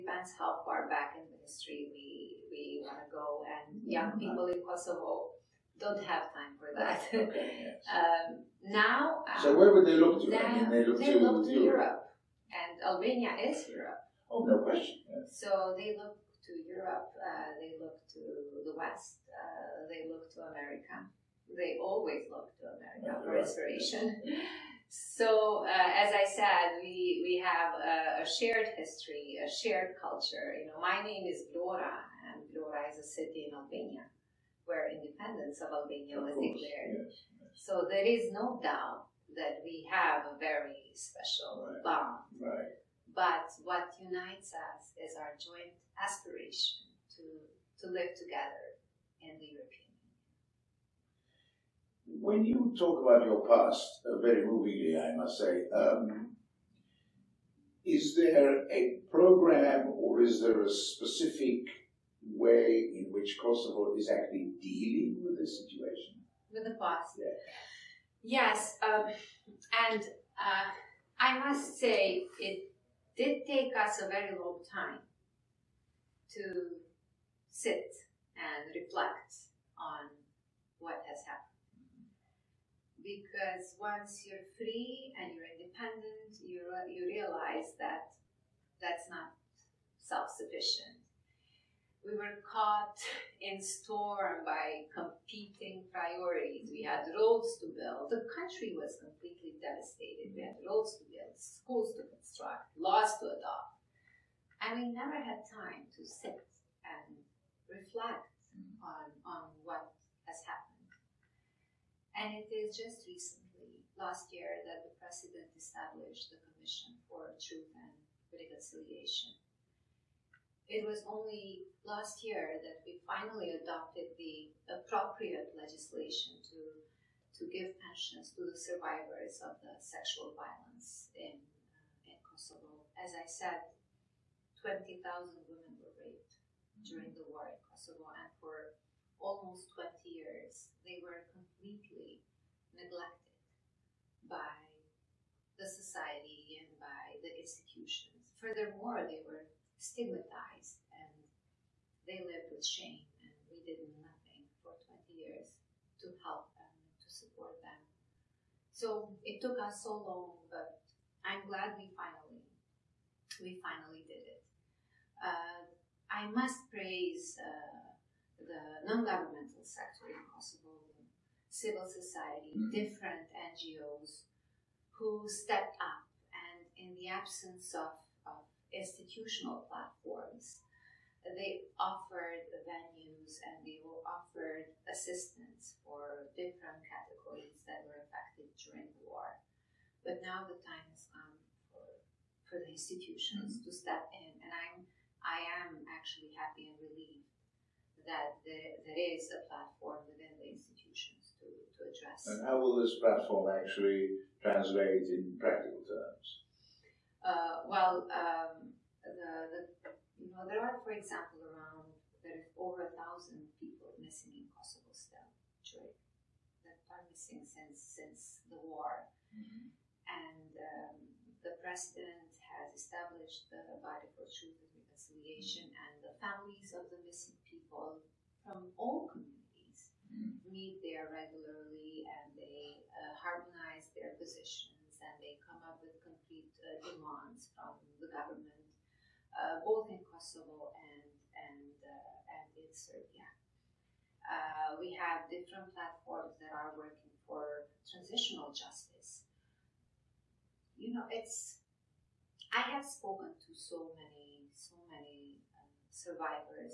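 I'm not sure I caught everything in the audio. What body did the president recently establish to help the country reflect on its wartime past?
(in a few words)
Commission for Truth and Reconciliation.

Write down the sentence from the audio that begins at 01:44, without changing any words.
And we never had time to sit and reflect mm-hmm.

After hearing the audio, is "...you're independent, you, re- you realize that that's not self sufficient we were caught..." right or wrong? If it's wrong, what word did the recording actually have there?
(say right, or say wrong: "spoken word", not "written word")
right.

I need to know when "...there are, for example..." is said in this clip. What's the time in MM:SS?
03:30.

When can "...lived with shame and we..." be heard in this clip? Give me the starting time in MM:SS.
02:32.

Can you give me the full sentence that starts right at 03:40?
and um, the president has established the body for truth and reconciliation, mm-hmm.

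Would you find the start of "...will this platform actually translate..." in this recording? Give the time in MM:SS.
03:22.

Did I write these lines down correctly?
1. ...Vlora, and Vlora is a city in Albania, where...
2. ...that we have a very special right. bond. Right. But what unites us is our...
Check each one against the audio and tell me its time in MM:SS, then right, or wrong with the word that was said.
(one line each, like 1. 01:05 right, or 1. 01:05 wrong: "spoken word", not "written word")
1. 00:31 right
2. 00:39 right.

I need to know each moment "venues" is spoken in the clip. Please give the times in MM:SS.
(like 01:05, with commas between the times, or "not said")
03:02.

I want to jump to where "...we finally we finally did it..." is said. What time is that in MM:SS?
02:41.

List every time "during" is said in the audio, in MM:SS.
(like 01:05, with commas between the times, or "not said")
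02:16, 03:08.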